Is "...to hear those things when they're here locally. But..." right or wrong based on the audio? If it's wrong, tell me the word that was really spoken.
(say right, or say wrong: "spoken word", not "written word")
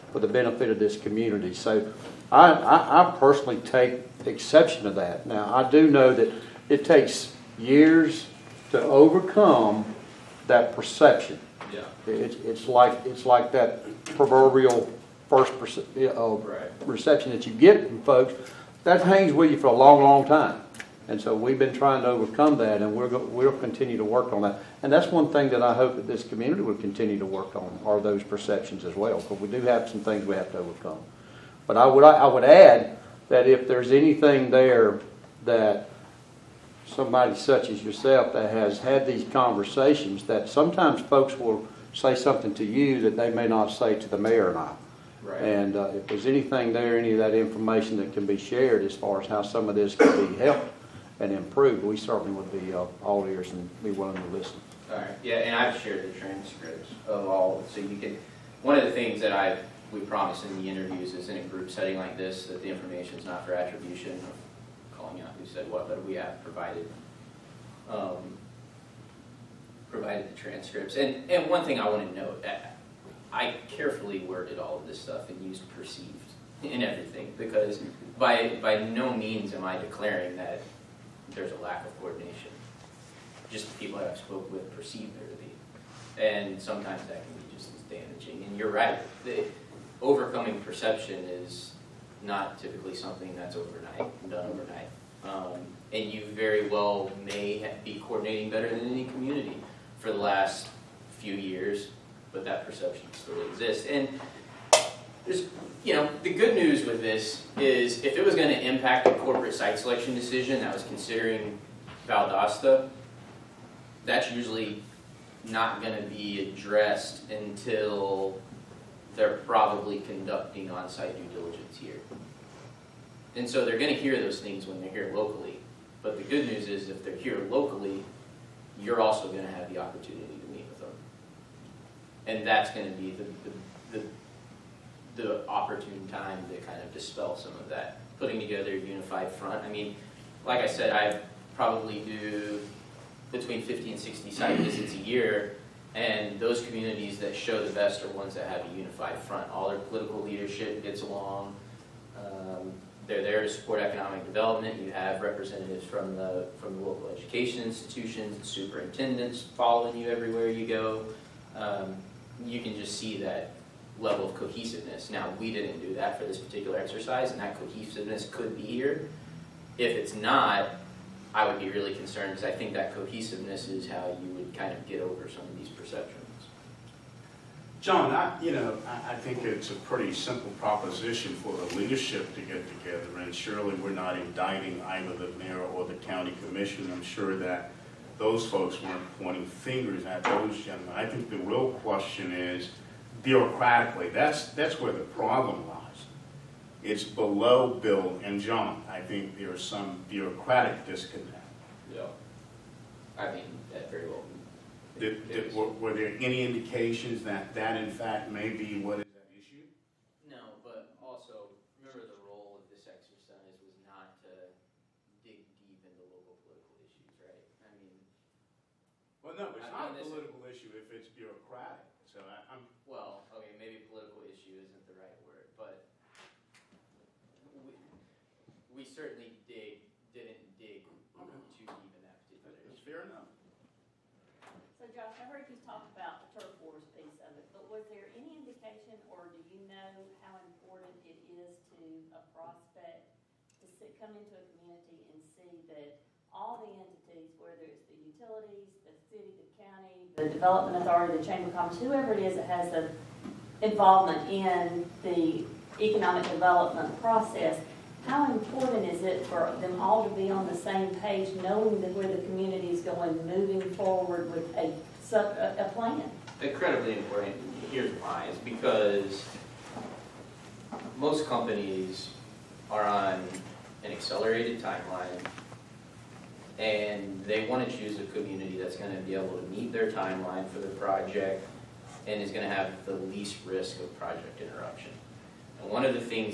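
right.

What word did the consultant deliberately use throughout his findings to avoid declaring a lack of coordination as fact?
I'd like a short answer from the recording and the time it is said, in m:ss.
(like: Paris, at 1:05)
perceived, at 1:15.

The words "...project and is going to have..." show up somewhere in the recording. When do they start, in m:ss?
4:40.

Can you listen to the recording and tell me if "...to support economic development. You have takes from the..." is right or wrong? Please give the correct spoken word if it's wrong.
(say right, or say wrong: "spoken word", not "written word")
wrong: "representatives", not "takes".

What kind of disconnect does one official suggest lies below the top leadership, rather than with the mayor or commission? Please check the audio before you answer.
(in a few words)
bureaucratic disconnect.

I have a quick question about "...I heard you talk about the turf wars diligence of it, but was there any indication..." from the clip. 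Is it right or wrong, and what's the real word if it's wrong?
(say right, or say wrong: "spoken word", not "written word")
wrong: "piece", not "diligence".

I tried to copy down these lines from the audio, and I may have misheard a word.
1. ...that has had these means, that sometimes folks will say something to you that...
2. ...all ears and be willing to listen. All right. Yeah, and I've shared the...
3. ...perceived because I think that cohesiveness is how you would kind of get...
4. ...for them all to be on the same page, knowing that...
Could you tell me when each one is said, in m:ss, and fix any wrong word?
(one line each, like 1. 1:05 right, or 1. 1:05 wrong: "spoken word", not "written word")
1. 0:38 wrong: "conversations", not "means"
2. 0:53 right
3. 2:51 wrong: "concerned", not "perceived"
4. 4:19 right.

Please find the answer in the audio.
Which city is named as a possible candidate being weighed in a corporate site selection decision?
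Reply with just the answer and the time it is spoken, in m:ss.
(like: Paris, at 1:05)
Valdosta, at 1:52.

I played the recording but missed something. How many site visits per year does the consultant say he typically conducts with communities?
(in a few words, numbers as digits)
50 to 60.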